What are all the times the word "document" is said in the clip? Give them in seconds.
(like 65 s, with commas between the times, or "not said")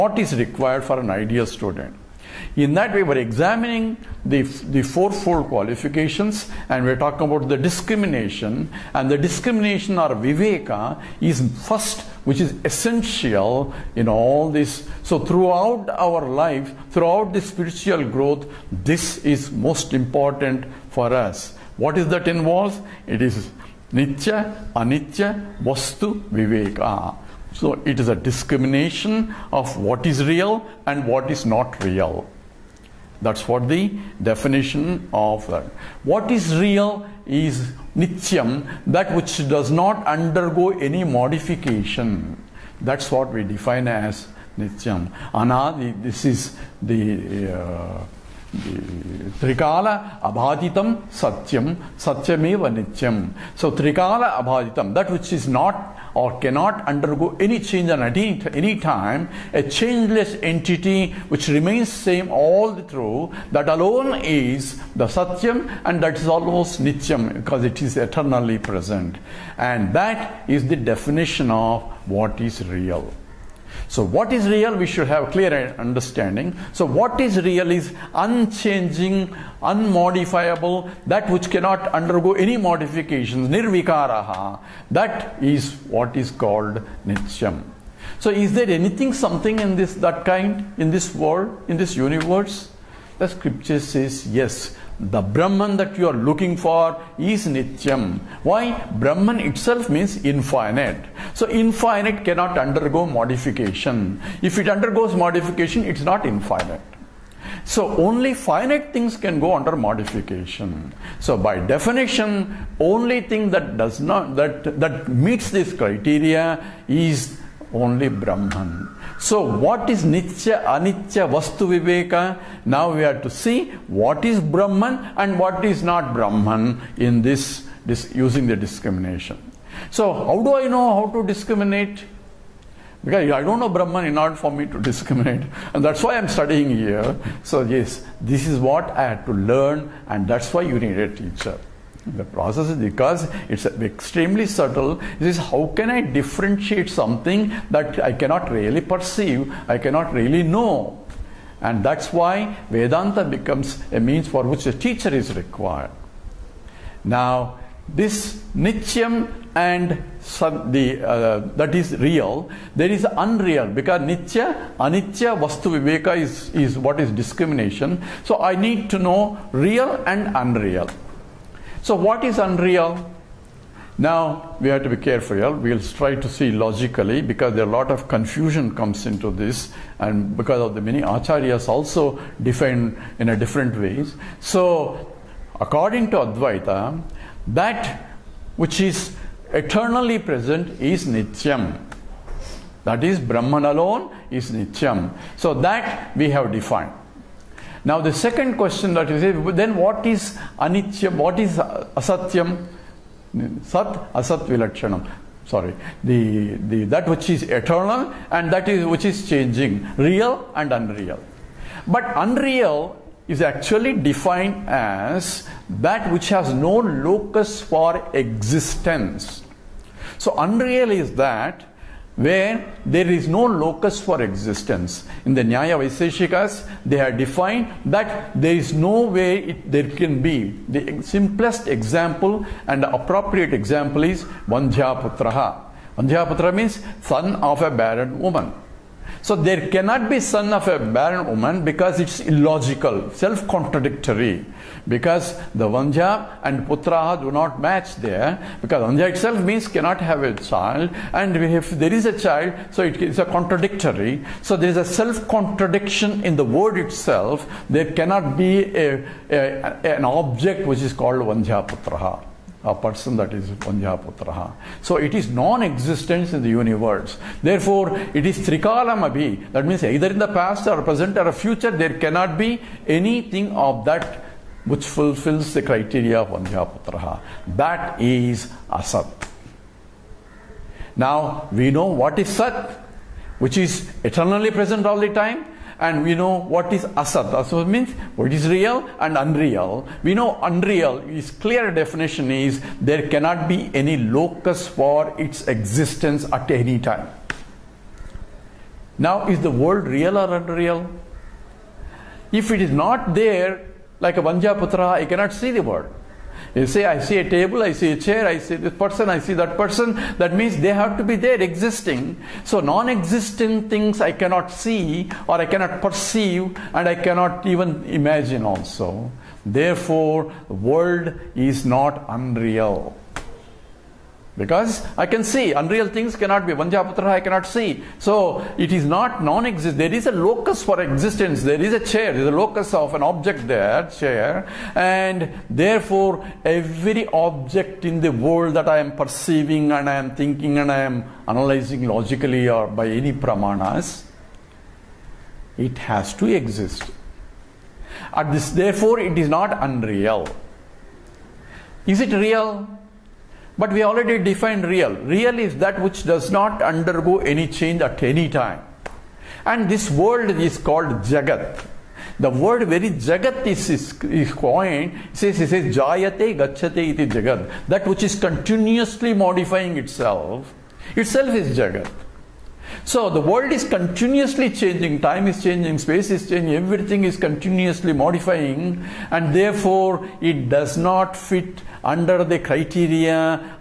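not said.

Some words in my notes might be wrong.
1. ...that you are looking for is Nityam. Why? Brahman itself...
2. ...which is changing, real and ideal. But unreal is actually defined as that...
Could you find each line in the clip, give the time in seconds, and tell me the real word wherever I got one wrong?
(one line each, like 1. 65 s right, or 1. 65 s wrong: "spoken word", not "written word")
1. 95 s right
2. 208 s wrong: "unreal", not "ideal".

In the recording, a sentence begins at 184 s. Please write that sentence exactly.
So, according to Advaita, that which is eternally present is Nityam.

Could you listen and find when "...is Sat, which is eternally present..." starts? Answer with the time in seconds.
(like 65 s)
282 s.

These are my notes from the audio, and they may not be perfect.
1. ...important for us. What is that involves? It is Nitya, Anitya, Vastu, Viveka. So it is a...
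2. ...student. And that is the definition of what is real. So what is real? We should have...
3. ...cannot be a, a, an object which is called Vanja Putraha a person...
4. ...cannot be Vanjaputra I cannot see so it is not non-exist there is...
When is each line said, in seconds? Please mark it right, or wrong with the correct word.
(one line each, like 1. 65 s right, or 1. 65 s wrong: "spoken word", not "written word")
1. 19 s right
2. 68 s wrong: "present", not "student"
3. 257 s right
4. 326 s right.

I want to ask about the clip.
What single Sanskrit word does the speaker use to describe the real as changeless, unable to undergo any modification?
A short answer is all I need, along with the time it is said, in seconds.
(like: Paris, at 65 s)
nirvikaraha, at 83 s.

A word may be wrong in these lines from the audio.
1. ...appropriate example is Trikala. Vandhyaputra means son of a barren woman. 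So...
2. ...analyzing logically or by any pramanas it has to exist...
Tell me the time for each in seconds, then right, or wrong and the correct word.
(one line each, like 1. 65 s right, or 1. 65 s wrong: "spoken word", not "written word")
1. 232 s wrong: "Vandhyaputraha", not "Trikala"
2. 341 s right.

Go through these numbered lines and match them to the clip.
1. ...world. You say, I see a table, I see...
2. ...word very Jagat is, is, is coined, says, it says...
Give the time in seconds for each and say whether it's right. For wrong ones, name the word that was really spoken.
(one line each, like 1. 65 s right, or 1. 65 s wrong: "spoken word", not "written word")
1. 305 s right
2. 362 s right.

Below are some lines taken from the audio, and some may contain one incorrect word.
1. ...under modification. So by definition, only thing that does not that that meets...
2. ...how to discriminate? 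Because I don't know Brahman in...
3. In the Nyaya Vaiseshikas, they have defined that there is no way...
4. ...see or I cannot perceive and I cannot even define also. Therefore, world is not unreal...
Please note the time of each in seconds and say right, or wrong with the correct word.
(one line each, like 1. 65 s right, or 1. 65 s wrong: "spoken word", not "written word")
1. 109 s right
2. 131 s right
3. 225 s right
4. 314 s wrong: "imagine", not "define".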